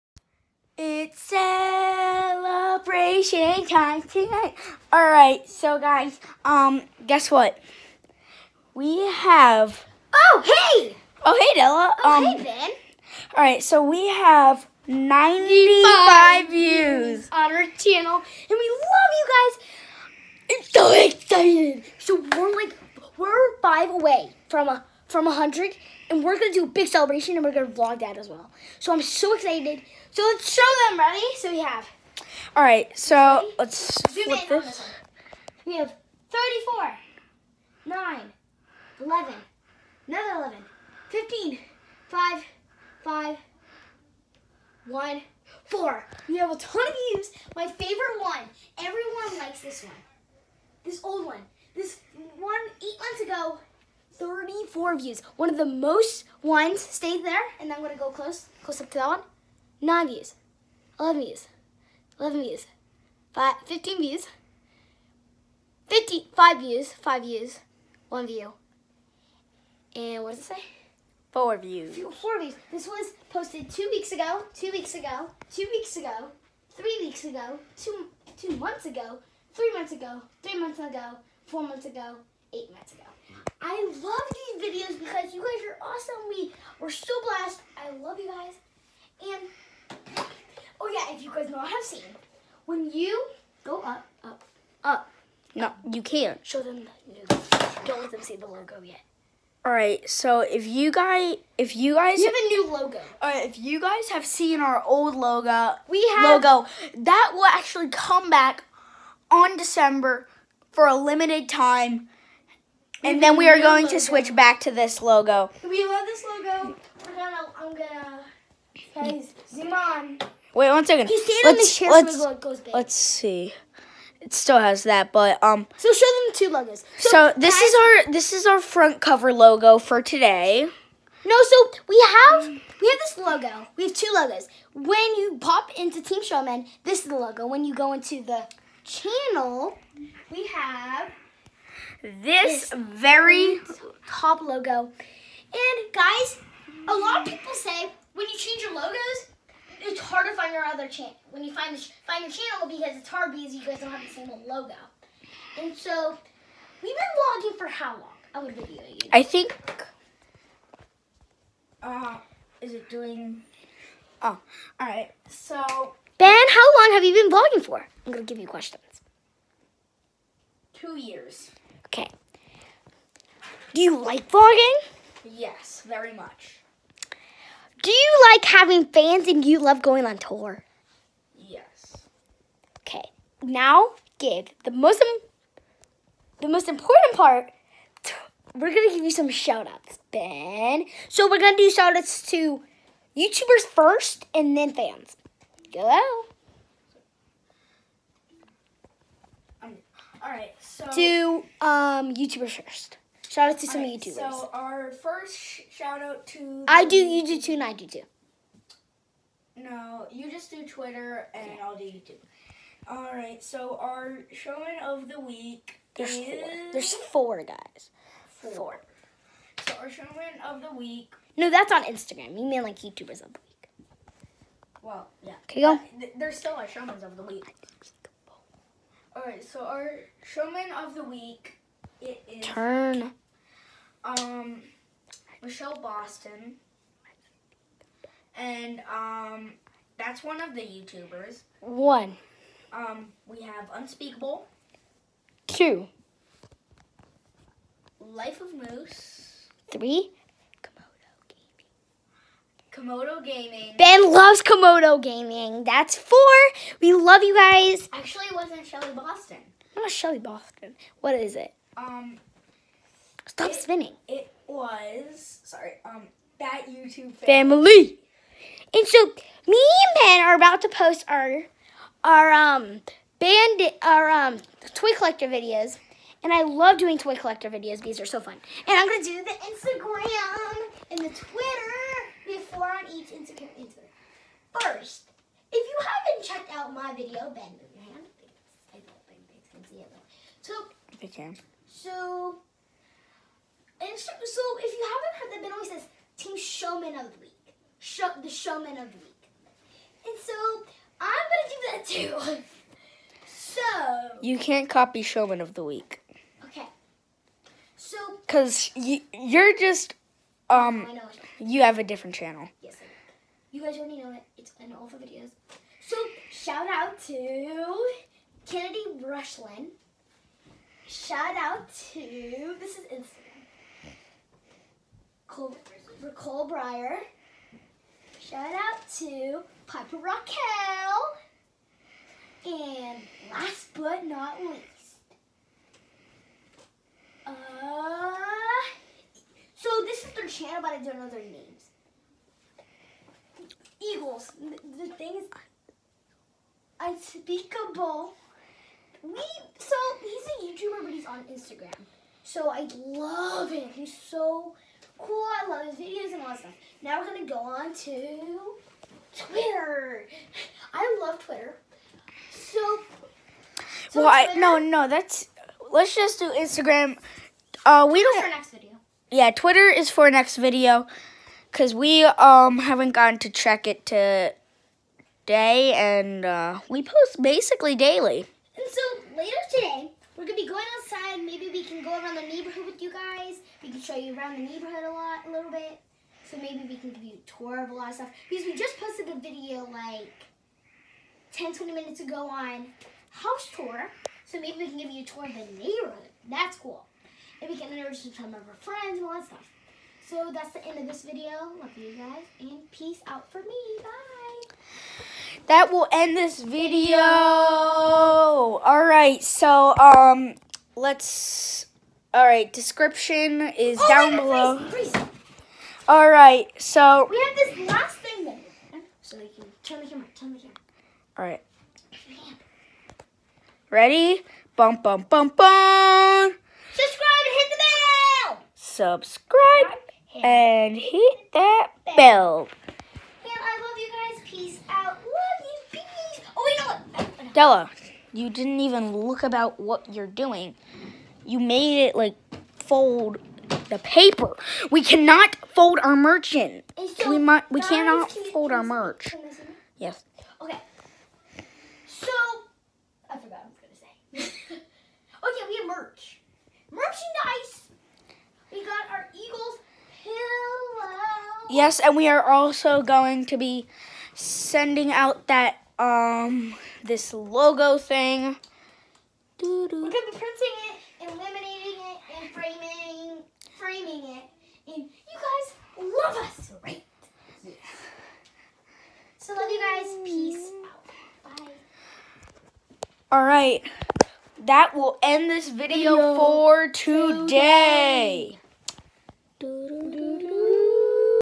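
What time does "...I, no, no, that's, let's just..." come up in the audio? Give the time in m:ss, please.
6:04.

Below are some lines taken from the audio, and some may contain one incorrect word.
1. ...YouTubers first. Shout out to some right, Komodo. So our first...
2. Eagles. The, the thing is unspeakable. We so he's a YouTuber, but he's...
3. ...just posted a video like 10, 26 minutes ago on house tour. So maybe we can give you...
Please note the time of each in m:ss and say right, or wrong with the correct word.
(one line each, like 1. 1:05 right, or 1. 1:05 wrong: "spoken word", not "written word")
1. 3:22 wrong: "YouTubers", not "Komodo"
2. 5:43 right
3. 6:28 wrong: "20", not "26".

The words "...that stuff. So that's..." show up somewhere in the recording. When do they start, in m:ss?
6:39.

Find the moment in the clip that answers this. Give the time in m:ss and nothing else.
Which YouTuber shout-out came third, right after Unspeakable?
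4:07.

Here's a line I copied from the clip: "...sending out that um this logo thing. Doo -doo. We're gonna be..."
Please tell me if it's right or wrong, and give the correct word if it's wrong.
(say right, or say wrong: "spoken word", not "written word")
right.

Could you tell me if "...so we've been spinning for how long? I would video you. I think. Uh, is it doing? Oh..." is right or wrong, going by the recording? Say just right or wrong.
wrong.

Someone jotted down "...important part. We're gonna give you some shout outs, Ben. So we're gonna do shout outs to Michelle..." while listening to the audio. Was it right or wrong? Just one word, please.
wrong.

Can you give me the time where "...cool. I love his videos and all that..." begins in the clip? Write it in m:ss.
5:55.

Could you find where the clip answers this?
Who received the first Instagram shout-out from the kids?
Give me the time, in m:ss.
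5:18.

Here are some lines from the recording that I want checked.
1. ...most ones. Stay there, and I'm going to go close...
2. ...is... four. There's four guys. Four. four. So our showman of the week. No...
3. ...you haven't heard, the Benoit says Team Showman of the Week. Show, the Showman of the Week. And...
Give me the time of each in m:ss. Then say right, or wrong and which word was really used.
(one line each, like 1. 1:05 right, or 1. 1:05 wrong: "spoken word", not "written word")
1. 0:55 right
2. 3:36 right
3. 4:54 right.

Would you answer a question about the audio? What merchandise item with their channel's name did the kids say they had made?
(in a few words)
Eagles pillow.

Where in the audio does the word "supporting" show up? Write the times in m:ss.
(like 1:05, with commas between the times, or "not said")
not said.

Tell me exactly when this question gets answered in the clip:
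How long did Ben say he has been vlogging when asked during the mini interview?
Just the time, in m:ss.
2:50.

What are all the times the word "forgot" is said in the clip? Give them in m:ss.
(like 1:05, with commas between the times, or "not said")
7:33.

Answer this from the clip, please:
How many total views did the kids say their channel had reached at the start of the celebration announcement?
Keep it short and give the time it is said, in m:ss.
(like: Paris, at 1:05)
95, at 0:14.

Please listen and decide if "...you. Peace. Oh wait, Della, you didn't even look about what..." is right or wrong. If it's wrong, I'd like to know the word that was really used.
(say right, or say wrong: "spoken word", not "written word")
right.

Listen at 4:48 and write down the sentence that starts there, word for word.
I don't think it's can see it though.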